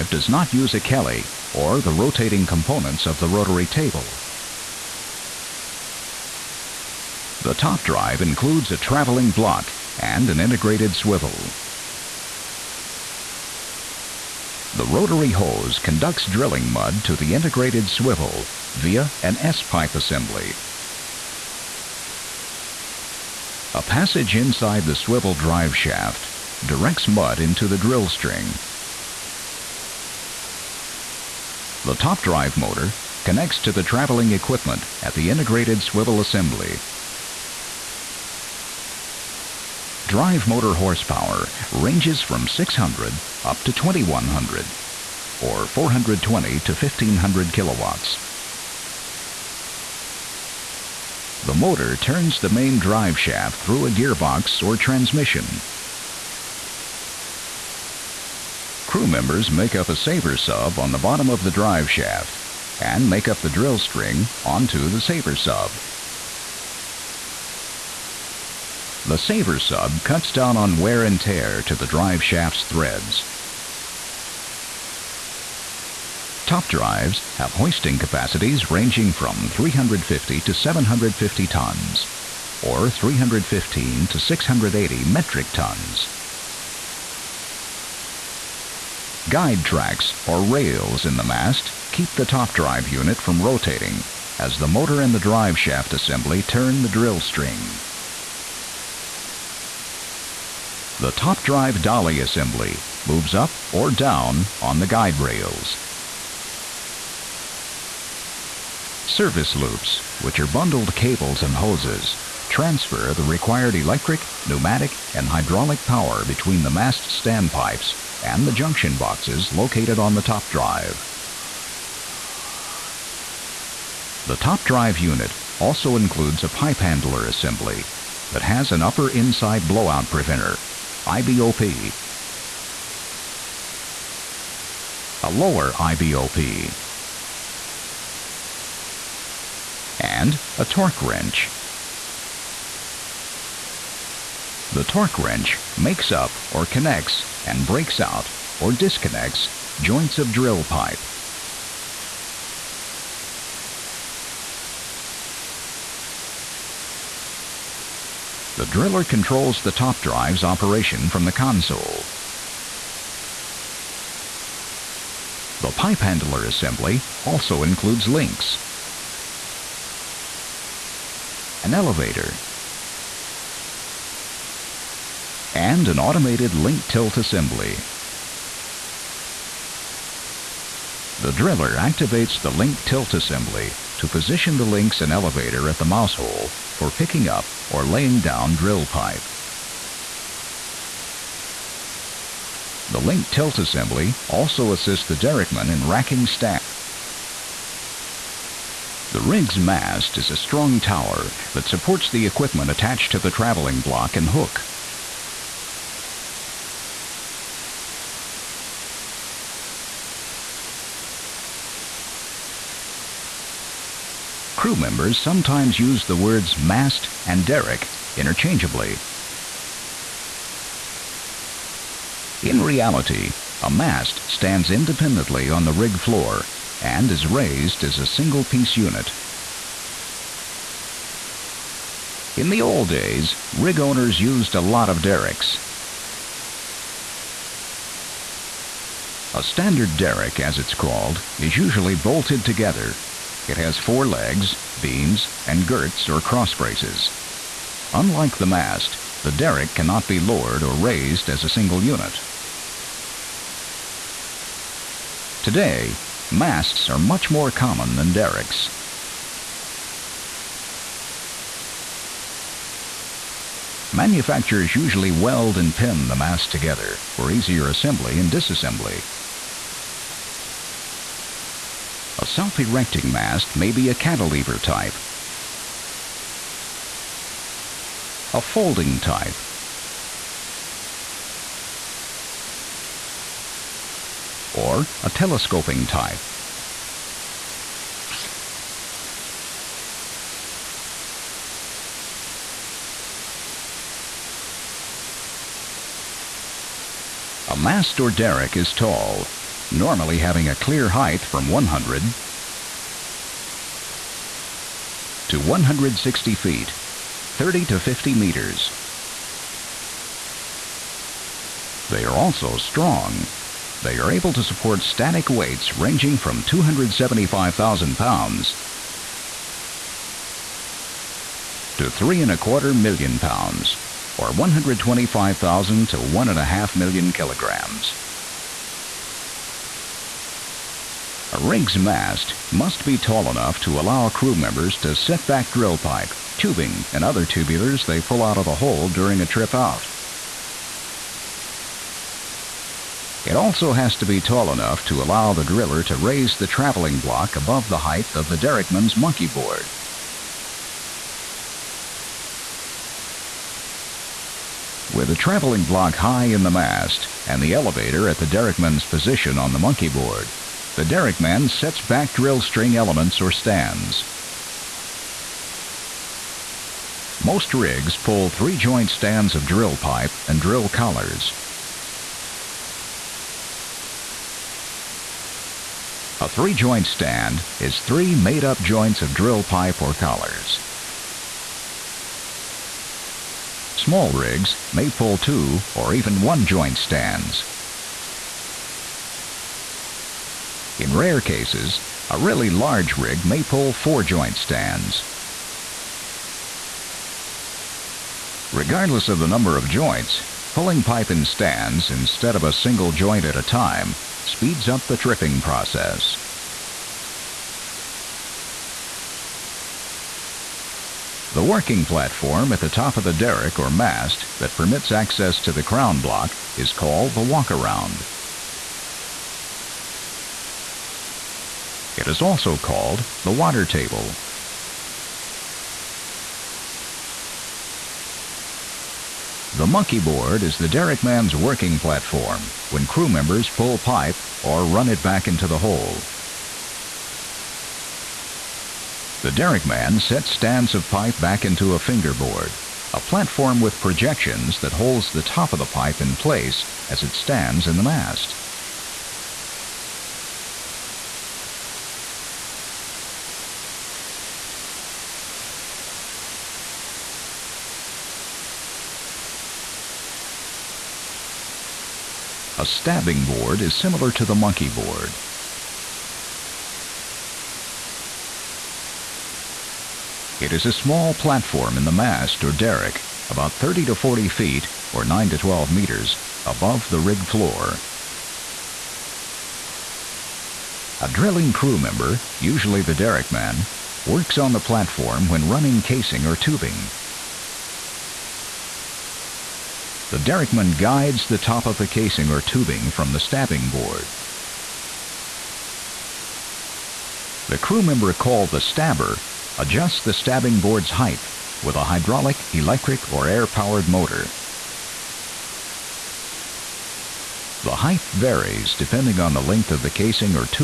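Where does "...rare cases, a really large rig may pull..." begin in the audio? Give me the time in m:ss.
6:30.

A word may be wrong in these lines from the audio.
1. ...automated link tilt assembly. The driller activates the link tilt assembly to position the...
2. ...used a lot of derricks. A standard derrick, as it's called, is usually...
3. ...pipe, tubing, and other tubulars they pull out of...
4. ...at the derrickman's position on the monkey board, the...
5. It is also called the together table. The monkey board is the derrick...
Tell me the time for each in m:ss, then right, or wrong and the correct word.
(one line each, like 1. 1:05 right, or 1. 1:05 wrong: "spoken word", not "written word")
1. 2:55 right
2. 3:54 right
3. 5:35 right
4. 5:58 right
5. 7:01 wrong: "water", not "together".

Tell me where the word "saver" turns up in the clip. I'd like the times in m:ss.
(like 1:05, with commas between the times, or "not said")
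0:59, 1:05, 1:09.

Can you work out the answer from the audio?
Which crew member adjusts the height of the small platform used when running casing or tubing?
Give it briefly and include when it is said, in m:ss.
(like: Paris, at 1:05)
the stabber, at 8:18.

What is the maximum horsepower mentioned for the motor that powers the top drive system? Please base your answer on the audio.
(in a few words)
2100.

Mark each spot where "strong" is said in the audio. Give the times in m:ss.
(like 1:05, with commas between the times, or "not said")
3:20, 5:12.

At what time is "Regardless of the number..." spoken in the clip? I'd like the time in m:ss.
6:38.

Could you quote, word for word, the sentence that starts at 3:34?
crew members sometimes use the words mast and derrick interchangeably.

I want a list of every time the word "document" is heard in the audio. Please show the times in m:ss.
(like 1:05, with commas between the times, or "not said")
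not said.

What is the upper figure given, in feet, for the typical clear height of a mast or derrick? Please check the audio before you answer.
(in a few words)
160 feet.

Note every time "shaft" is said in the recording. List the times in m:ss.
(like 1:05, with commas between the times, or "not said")
0:25, 0:53, 1:01, 1:12, 1:35.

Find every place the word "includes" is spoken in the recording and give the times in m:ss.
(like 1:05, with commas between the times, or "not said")
0:08, 2:05, 2:47.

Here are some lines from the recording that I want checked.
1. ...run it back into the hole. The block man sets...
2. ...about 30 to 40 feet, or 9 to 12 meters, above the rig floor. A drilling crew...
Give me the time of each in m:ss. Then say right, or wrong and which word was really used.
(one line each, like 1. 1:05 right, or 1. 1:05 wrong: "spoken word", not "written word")
1. 7:14 wrong: "derrick", not "block"
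2. 7:53 right.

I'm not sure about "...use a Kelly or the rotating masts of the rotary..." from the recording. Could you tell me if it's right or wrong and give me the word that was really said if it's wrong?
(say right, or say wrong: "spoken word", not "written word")
wrong: "components", not "masts".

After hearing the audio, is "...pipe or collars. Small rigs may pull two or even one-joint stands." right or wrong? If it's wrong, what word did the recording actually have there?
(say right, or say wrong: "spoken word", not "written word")
right.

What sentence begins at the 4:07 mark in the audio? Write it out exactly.
Unlike the mast, the derrick cannot be lowered or raised as a single unit.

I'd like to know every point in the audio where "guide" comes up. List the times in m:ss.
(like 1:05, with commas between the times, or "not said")
1:29, 1:44, 8:10.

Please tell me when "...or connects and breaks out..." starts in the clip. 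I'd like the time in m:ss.
2:26.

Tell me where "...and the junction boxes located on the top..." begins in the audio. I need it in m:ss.
1:58.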